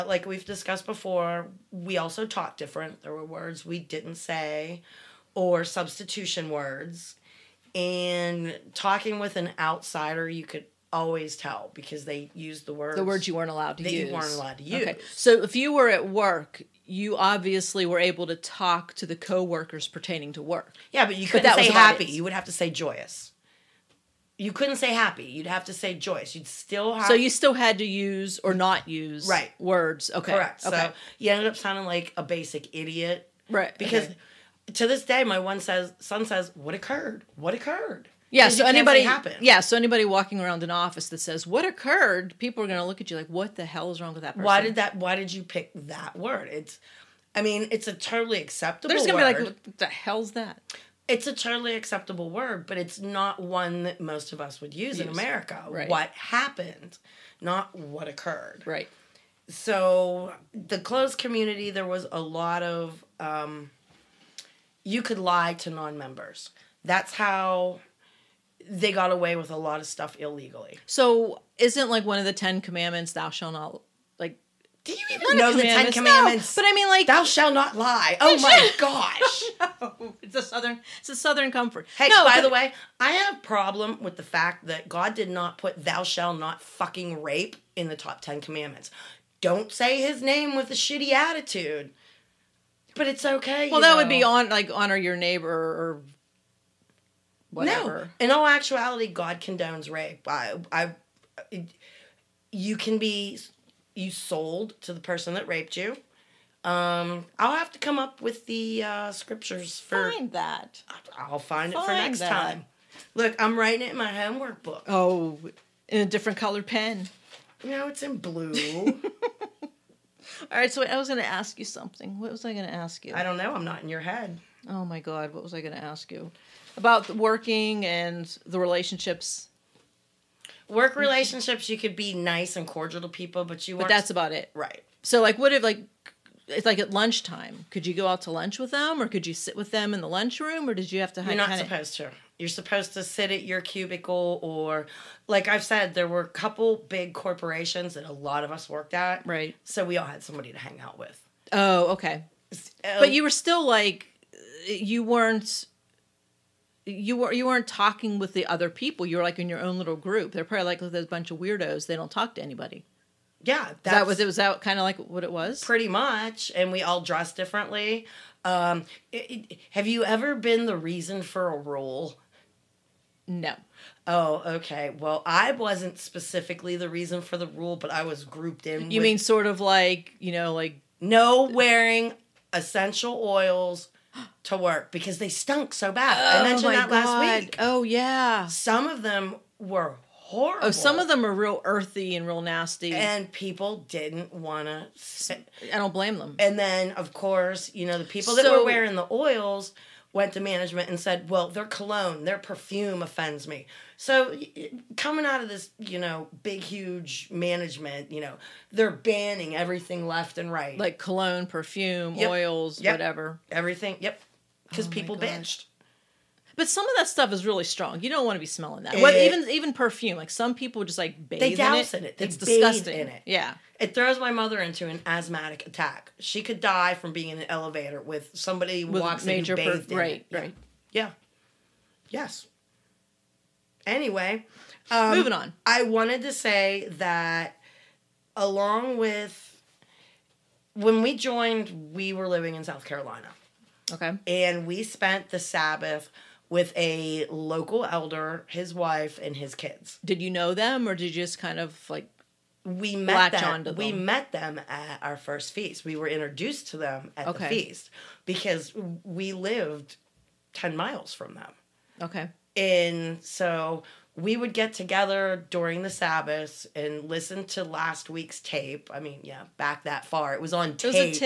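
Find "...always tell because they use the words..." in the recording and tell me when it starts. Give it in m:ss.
0:10.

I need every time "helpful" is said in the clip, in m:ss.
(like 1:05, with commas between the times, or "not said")
not said.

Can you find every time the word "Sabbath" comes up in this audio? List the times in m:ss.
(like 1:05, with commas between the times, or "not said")
4:05, 4:25.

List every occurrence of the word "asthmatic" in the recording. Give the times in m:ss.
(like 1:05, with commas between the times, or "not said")
3:45.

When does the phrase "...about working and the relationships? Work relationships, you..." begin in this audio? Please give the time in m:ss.
2:06.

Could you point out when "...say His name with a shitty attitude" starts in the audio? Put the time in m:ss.
1:29.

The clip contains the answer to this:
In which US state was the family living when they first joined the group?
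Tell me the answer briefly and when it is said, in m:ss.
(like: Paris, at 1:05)
South Carolina, at 4:02.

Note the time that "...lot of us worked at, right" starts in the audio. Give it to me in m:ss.
2:28.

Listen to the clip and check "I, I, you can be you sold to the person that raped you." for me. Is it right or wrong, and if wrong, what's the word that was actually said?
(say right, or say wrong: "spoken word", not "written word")
right.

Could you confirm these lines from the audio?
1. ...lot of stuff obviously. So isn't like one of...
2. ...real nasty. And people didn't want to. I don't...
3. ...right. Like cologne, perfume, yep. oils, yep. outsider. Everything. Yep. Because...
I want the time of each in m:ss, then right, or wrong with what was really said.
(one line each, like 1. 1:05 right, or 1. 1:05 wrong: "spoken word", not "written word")
1. 1:09 wrong: "illegally", not "obviously"
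2. 3:12 right
3. 3:30 wrong: "whatever", not "outsider".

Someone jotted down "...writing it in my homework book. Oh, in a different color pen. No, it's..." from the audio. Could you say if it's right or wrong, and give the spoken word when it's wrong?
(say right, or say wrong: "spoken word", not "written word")
right.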